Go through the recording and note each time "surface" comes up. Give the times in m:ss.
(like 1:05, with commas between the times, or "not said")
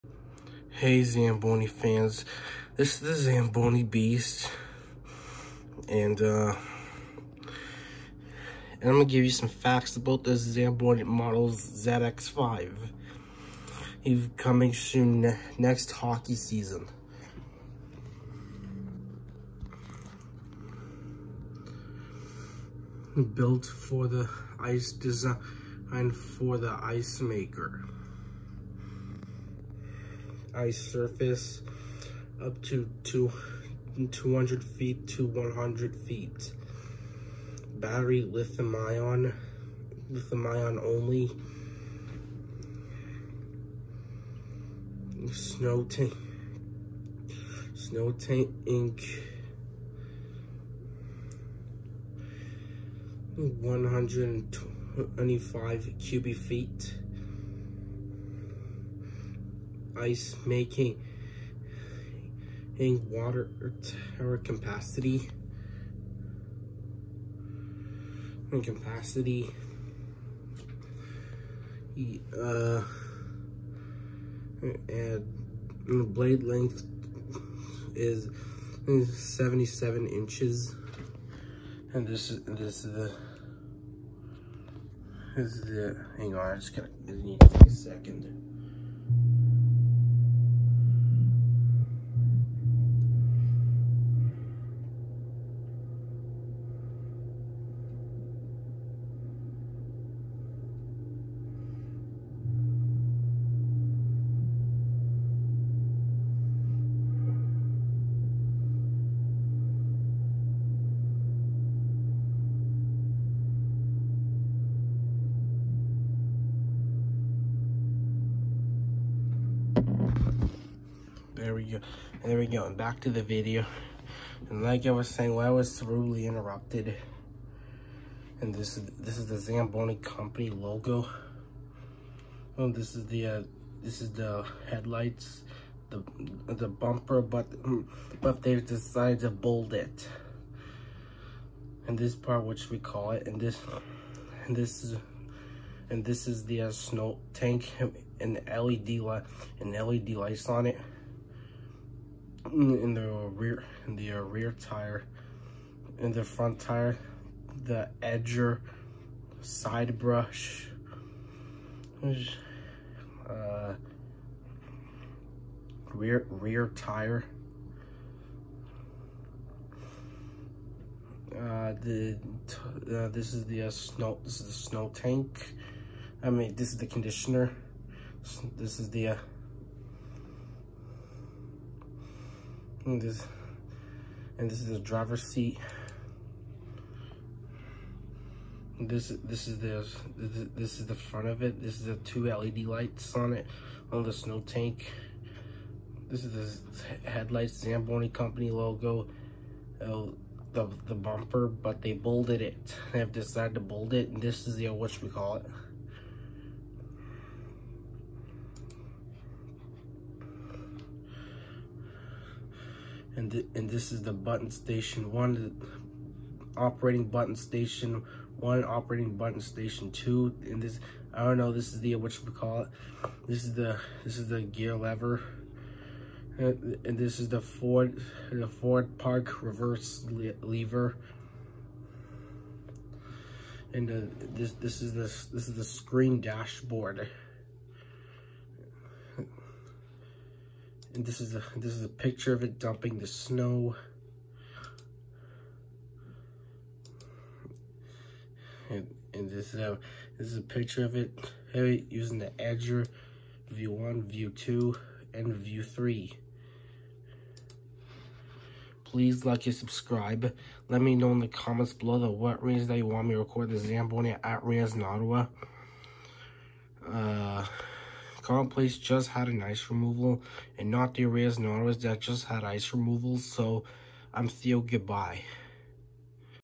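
0:30.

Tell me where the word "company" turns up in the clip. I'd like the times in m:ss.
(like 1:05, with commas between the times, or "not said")
2:09, 3:18.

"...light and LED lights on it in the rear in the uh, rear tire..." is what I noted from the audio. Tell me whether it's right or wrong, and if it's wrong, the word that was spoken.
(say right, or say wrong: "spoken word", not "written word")
right.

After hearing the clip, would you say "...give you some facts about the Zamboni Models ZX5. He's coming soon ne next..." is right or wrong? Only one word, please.
right.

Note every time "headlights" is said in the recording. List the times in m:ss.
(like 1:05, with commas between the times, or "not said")
2:14, 3:17.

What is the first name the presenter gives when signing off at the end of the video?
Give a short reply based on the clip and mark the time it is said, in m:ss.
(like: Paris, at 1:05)
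Theo, at 4:34.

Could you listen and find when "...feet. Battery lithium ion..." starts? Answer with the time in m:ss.
0:35.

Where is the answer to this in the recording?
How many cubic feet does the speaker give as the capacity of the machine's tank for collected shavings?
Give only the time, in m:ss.
0:53.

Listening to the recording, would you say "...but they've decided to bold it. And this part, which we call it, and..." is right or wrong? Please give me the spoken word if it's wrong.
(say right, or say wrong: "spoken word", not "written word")
right.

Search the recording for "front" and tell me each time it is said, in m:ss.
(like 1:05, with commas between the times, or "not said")
2:36, 3:10.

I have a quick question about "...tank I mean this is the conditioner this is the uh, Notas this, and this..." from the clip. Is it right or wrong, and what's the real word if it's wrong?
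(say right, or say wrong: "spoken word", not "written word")
wrong: "And", not "Notas".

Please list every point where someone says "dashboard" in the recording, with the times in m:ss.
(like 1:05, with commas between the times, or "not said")
3:56.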